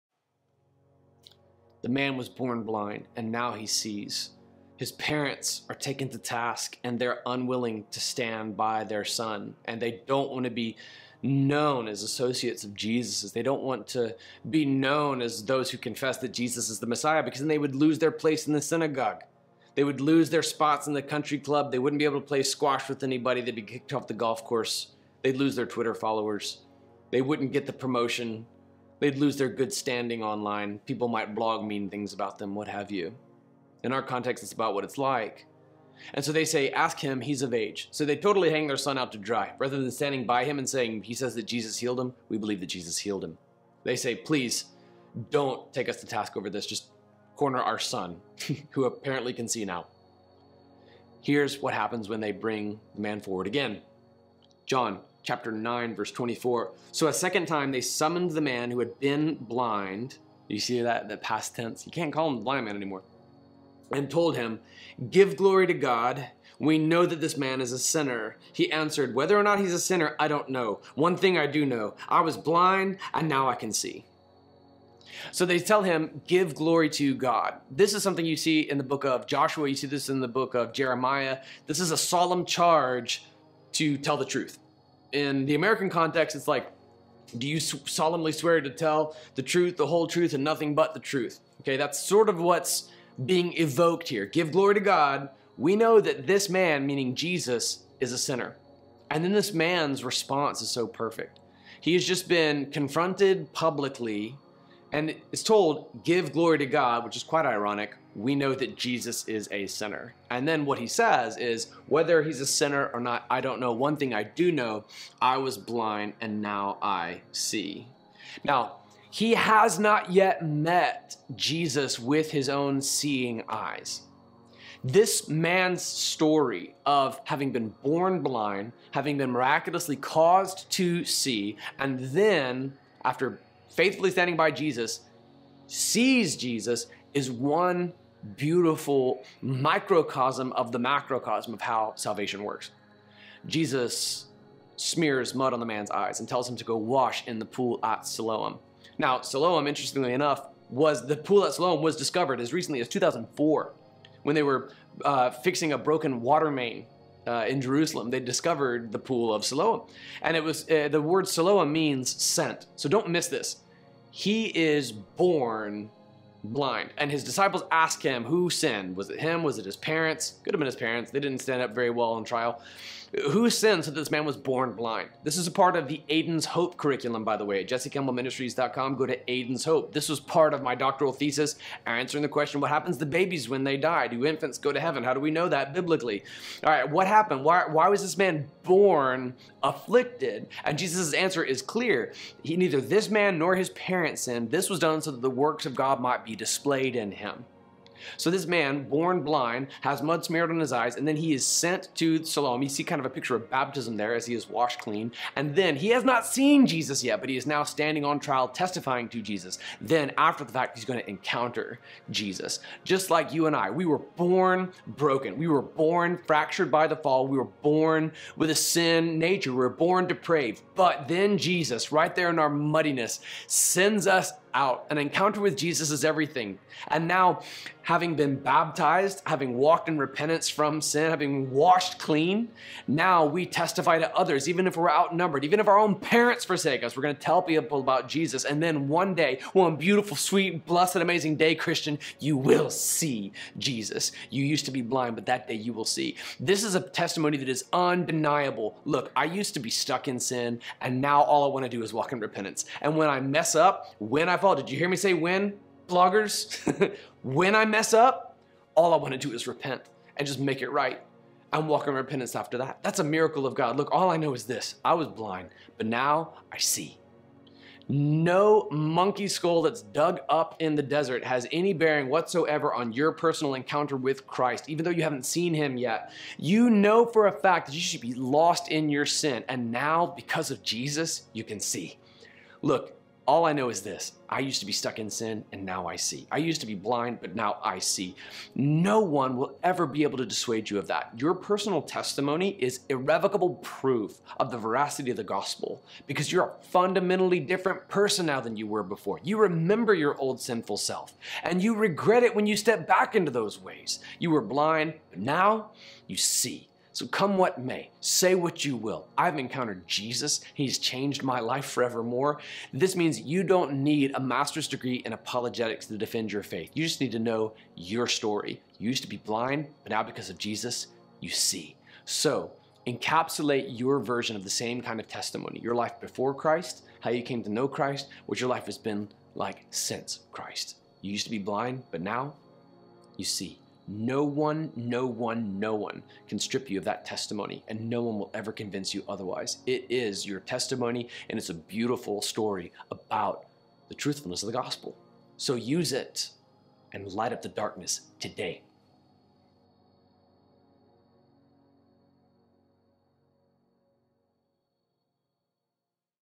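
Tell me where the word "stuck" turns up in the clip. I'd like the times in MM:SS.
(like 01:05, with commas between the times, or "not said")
04:09, 04:44.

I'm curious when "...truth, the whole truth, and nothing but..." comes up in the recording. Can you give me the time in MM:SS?
01:29.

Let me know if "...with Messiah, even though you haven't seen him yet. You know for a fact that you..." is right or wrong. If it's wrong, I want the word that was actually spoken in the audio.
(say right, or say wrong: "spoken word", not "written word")
wrong: "Christ", not "Messiah".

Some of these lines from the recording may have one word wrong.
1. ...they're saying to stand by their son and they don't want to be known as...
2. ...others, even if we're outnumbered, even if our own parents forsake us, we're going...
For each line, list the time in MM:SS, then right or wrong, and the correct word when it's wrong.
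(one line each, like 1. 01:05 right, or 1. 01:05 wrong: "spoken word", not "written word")
1. 00:06 wrong: "unwilling", not "saying"
2. 03:54 right.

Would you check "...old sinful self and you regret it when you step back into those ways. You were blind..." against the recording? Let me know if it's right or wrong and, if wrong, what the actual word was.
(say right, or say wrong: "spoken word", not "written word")
right.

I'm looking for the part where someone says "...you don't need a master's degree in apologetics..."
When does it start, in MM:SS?
05:13.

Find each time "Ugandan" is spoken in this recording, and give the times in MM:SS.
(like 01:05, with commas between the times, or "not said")
not said.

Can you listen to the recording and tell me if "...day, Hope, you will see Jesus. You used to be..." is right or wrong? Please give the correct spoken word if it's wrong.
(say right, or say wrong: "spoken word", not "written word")
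wrong: "Christian", not "Hope".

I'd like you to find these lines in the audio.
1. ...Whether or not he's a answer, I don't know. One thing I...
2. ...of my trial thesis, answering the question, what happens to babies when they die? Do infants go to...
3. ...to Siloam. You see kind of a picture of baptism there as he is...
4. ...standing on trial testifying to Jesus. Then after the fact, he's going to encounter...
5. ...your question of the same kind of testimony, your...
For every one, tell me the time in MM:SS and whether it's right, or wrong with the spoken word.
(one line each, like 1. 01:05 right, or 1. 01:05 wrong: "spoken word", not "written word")
1. 01:09 wrong: "sinner", not "answer"
2. 03:00 wrong: "doctoral", not "trial"
3. 03:21 right
4. 03:27 right
5. 05:23 wrong: "version", not "question".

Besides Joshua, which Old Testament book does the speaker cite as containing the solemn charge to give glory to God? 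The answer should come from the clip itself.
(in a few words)
Jeremiah.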